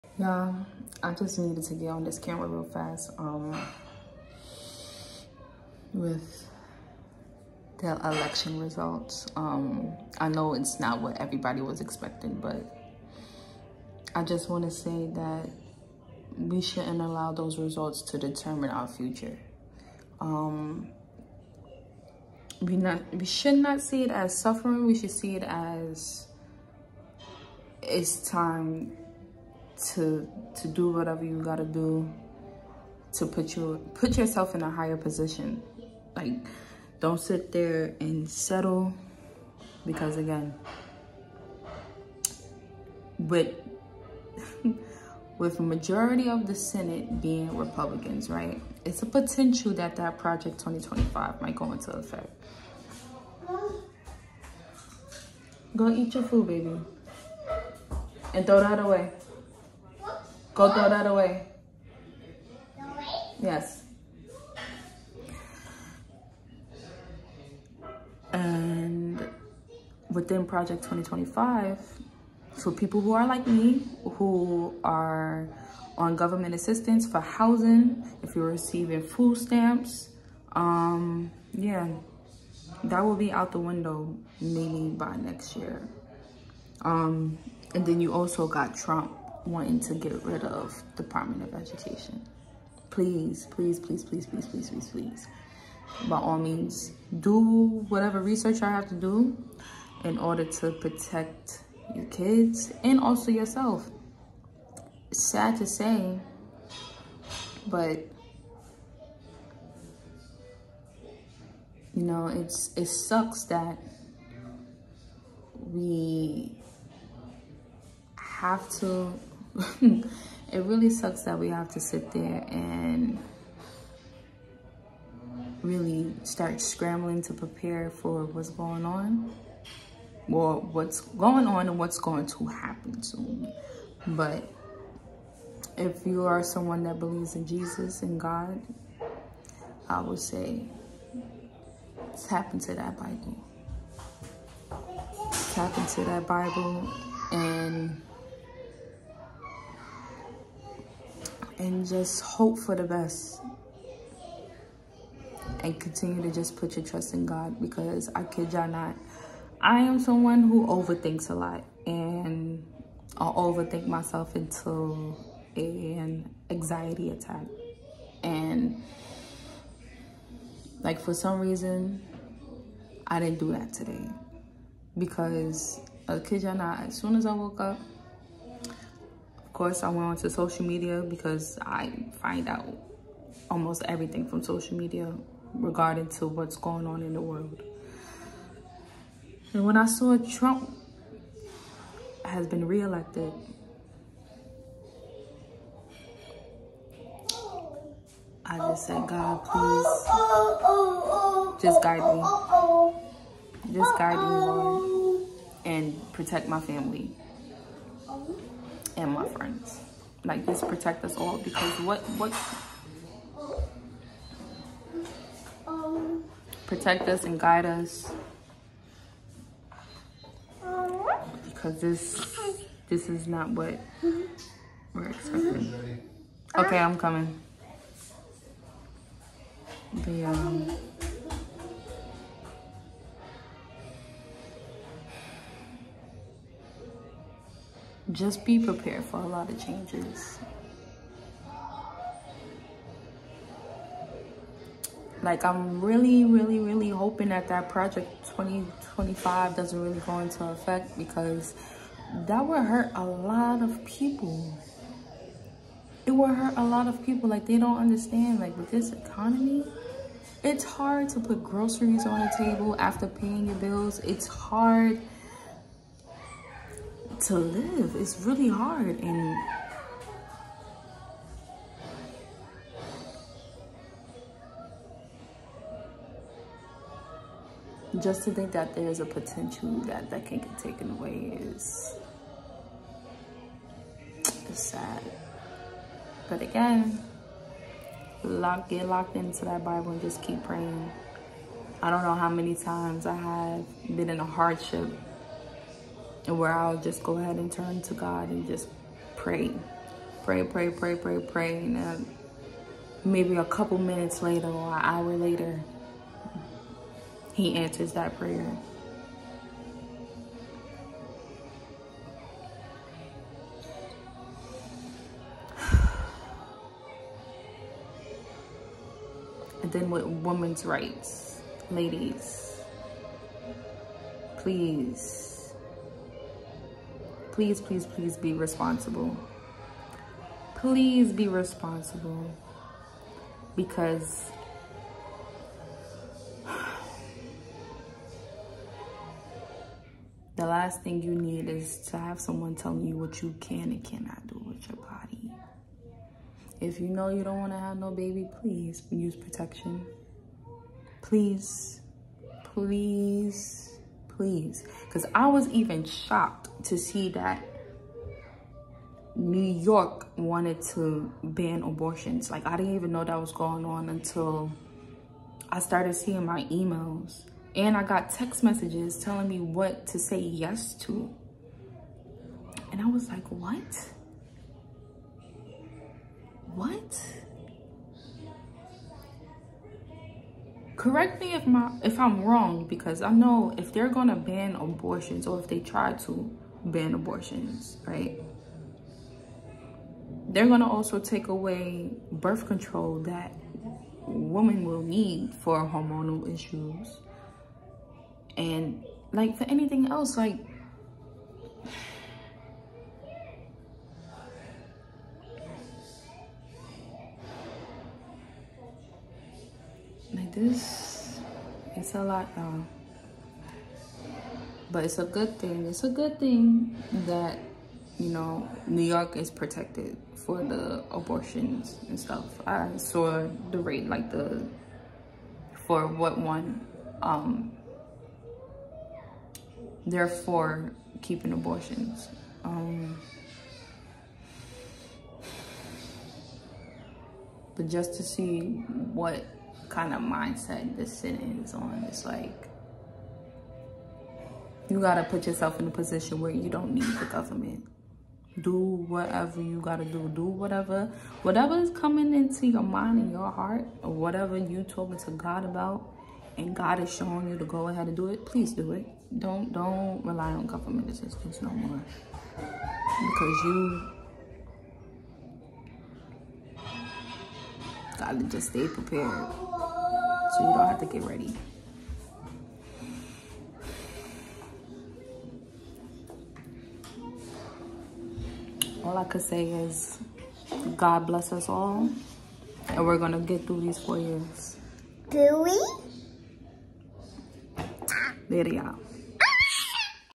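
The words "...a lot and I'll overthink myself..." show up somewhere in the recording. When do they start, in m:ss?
2:41.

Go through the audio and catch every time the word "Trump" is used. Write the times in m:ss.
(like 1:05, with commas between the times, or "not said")
1:28, 3:10.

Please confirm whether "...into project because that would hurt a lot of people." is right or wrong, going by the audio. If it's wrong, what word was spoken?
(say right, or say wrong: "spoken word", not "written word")
wrong: "effect", not "project".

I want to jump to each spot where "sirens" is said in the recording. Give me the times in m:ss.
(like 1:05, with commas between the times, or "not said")
not said.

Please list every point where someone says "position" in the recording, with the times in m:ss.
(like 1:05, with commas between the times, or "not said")
0:34, 7:25.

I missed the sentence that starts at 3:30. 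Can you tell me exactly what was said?
Like just protect us all because what what protect us and guide us because this this is not what we're expecting.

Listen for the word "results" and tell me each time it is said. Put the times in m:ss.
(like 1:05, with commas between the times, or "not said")
0:08, 0:17.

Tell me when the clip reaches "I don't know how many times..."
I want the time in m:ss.
4:51.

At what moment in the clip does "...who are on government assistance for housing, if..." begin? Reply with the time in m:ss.
1:14.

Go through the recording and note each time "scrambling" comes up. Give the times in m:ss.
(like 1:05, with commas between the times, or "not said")
2:06.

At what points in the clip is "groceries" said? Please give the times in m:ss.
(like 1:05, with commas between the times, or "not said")
4:21.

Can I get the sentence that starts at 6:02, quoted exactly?
Like, I didn't even know that was going on until I started seeing my emails.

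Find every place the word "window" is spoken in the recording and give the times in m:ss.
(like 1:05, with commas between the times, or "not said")
1:23.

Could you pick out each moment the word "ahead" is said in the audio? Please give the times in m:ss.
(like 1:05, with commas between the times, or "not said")
4:57, 7:37.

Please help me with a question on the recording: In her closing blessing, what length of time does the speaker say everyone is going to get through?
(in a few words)
4 years.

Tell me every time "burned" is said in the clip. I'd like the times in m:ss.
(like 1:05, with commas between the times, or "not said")
not said.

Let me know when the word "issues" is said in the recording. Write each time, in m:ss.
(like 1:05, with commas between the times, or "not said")
6:36.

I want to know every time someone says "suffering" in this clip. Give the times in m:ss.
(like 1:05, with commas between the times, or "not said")
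0:24.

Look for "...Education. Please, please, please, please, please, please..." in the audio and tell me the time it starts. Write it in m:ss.
1:31.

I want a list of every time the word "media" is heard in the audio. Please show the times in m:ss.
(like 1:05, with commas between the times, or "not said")
3:00, 3:04.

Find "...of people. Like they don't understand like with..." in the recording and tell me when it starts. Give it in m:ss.
4:16.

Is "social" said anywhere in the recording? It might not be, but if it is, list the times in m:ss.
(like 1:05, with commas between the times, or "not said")
3:00, 3:04.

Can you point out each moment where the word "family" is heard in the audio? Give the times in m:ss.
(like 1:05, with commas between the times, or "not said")
3:26.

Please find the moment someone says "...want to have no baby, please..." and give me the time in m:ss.
5:47.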